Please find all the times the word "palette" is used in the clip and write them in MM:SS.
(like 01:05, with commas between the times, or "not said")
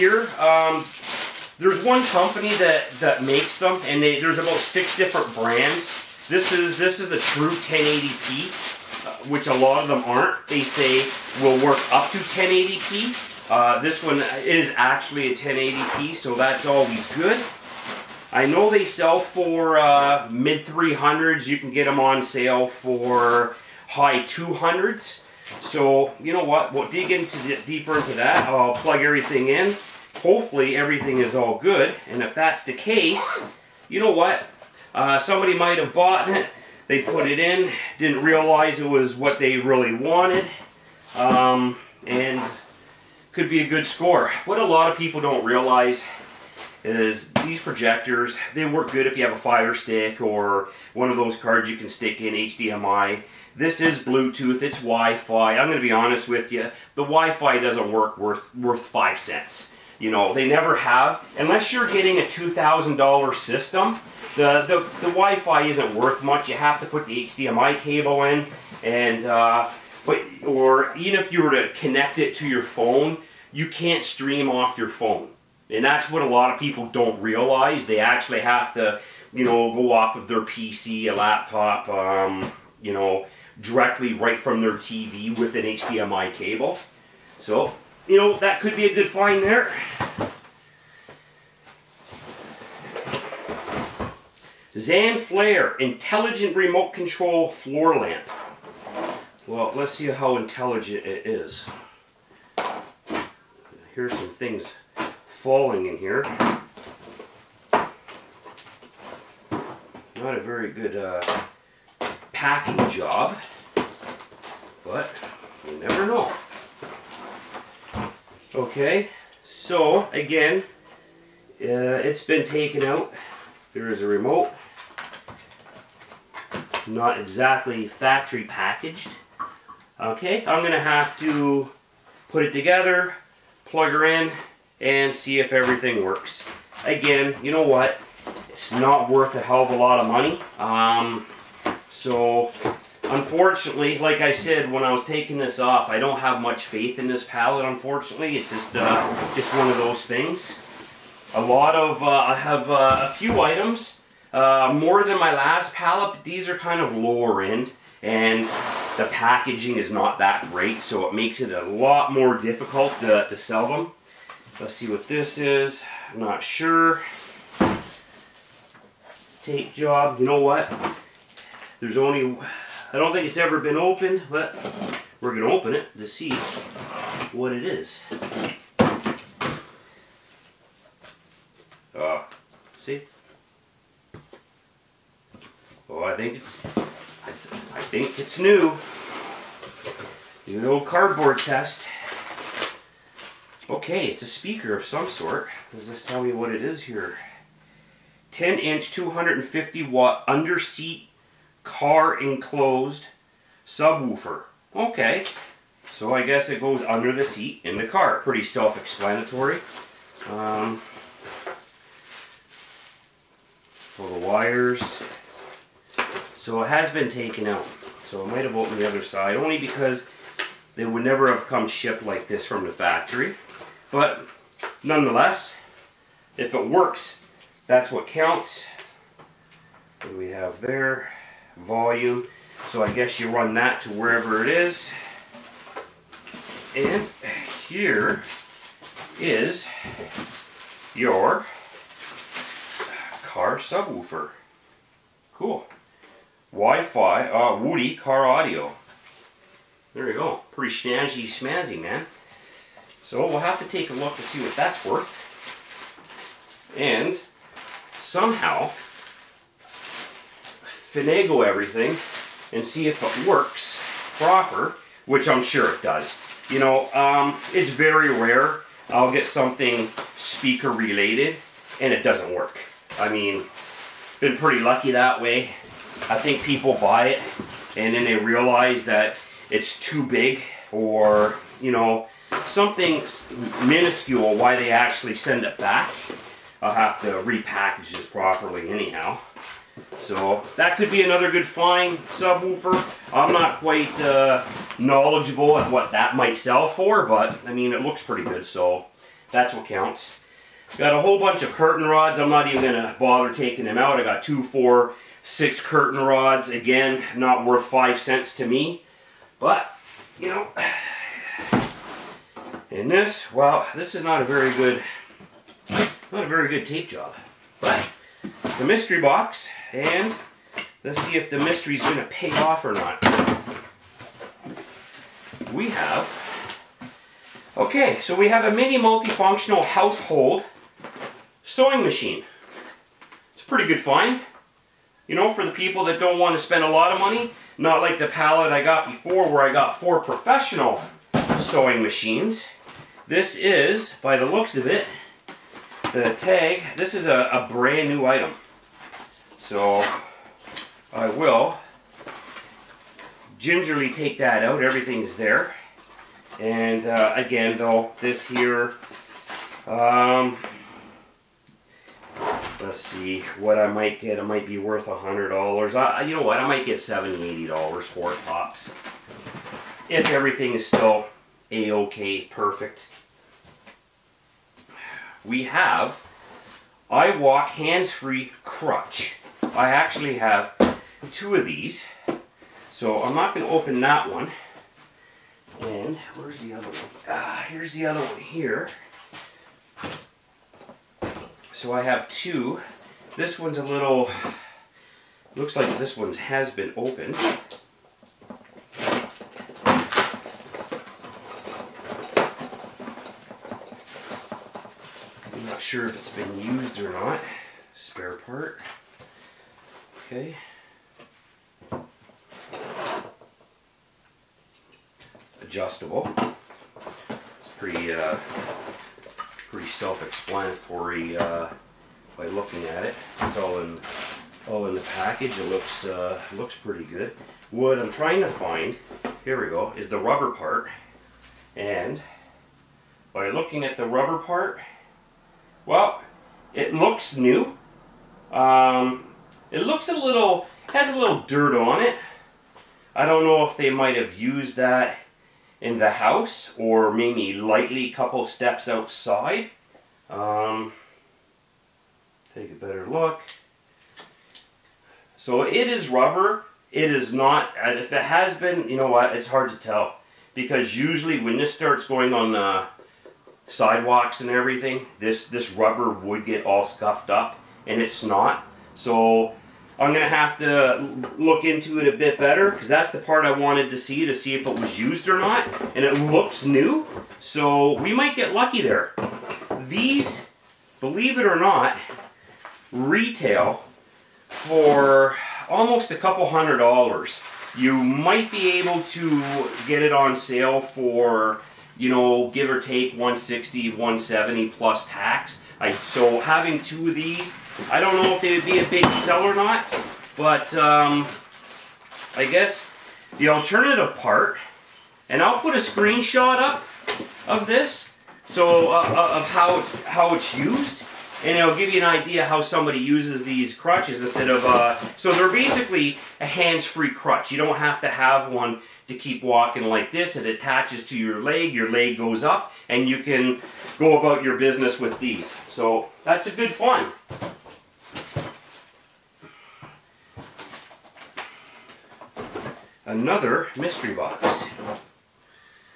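02:27, 02:35.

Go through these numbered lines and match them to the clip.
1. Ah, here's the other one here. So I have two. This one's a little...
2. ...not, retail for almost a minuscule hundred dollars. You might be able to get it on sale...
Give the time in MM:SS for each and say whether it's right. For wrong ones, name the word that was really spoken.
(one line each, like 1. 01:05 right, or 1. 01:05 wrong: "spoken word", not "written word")
1. 06:27 right
2. 08:01 wrong: "couple", not "minuscule".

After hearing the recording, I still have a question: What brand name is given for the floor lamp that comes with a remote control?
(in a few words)
Zanflare.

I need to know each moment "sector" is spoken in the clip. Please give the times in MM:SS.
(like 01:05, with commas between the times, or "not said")
not said.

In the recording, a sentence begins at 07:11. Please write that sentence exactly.
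And by looking at the rubber part, it looks new.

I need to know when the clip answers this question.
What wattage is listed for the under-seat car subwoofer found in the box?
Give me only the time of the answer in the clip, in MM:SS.
03:18.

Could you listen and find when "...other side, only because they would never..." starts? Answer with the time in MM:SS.
03:38.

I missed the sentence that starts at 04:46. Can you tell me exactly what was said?
I'll have to repackage this properly anyhow.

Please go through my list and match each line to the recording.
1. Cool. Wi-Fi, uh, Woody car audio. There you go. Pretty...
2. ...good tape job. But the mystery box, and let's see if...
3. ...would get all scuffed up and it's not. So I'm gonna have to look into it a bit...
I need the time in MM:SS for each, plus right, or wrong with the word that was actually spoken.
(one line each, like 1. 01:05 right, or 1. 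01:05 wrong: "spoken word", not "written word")
1. 04:05 right
2. 05:16 right
3. 07:45 right.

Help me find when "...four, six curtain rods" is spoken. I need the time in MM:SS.
05:04.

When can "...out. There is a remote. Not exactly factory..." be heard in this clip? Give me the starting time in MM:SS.
02:02.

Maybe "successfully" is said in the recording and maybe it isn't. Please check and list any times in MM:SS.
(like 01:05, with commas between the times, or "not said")
not said.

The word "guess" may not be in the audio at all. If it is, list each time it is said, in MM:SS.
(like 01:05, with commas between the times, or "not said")
03:26, 03:52, 08:22.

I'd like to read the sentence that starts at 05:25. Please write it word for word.
We have, okay, so we have a mini multifunctional household sewing machine.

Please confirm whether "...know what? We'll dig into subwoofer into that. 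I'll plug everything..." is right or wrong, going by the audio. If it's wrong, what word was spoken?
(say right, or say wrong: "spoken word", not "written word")
wrong: "deeper", not "subwoofer".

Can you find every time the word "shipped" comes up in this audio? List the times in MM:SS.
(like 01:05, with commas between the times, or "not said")
03:41.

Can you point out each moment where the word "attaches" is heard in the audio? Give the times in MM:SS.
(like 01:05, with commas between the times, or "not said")
08:40.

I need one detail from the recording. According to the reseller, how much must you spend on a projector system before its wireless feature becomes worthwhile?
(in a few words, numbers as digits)
$2,000.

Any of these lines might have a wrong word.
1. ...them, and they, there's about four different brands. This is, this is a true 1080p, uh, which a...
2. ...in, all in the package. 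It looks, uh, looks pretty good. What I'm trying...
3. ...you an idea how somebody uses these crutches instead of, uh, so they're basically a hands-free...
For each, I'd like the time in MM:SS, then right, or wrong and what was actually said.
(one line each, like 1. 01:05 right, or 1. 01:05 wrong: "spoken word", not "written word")
1. 00:03 wrong: "six", not "four"
2. 07:03 right
3. 08:31 right.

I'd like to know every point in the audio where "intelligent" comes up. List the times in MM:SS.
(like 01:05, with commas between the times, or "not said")
01:35, 01:40.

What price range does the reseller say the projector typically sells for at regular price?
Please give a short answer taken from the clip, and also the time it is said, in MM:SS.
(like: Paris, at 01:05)
mid 300s, at 00:20.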